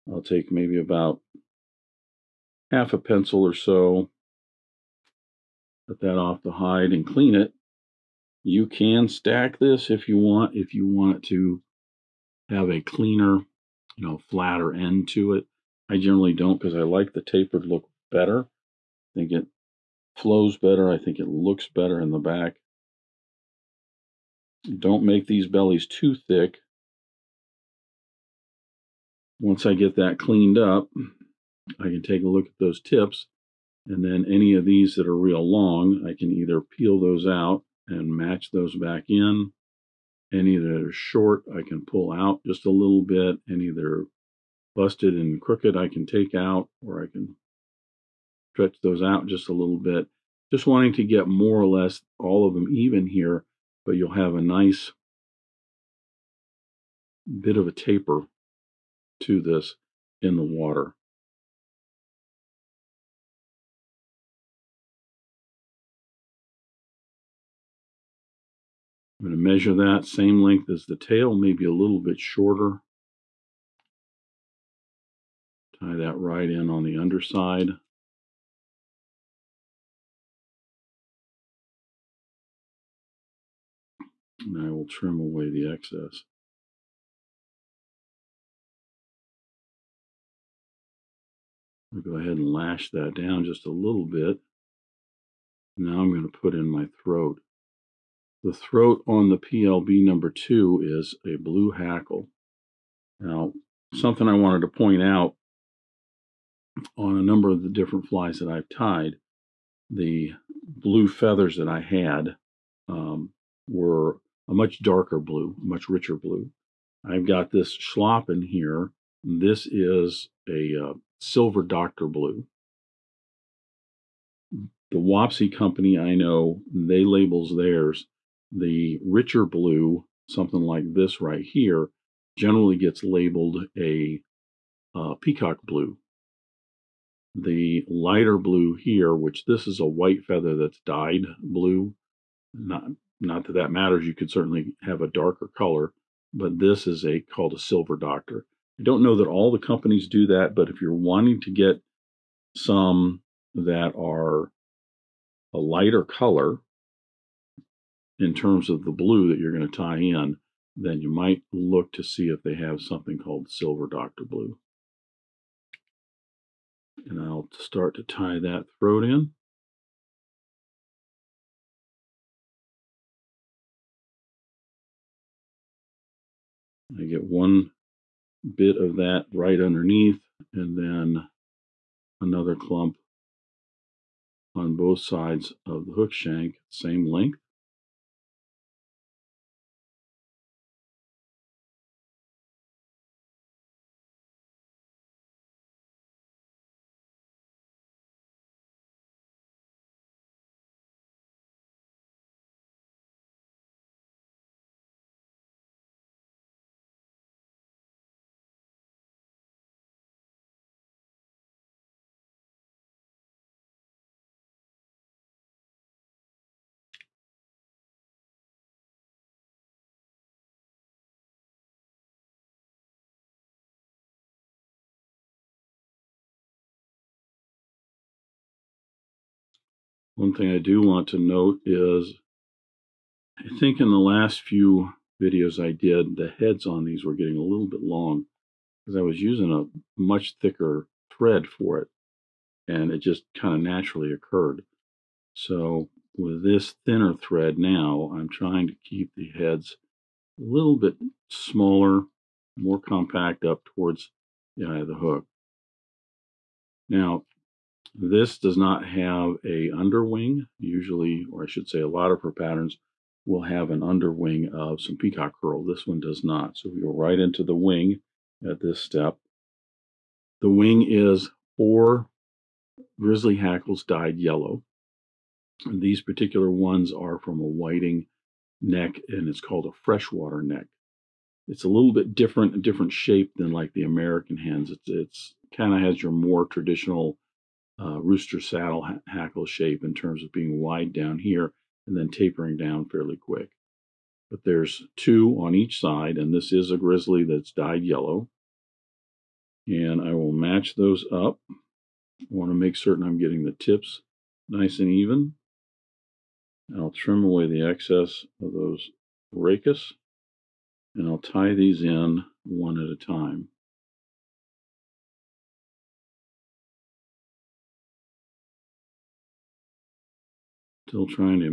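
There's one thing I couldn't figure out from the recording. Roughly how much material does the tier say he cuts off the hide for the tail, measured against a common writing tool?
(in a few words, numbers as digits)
half a pencil.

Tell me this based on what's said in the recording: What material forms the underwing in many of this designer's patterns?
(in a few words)
peacock curl.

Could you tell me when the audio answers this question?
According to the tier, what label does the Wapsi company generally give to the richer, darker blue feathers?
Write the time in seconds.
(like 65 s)
135 s.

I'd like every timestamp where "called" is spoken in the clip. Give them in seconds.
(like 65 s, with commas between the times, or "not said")
147 s, 163 s, 279 s.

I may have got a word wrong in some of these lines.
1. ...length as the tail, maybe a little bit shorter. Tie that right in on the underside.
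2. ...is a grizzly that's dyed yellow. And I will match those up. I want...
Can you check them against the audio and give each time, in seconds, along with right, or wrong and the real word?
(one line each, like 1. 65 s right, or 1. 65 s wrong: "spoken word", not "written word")
1. 70 s right
2. 296 s right.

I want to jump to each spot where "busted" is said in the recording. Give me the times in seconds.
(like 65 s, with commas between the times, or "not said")
44 s.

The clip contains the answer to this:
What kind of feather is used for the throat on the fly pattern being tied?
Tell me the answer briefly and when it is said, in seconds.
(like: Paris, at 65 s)
blue hackle, at 101 s.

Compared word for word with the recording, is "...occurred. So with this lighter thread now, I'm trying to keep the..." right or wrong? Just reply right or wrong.
wrong.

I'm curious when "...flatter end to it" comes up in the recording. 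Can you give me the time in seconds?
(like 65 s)
14 s.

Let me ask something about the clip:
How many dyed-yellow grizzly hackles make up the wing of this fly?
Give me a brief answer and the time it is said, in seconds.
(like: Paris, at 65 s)
4, at 271 s.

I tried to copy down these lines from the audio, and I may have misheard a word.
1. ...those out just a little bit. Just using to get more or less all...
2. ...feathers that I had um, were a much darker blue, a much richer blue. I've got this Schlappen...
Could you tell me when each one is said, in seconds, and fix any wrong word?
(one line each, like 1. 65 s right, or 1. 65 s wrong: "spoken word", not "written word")
1. 48 s wrong: "wanting", not "using"
2. 111 s right.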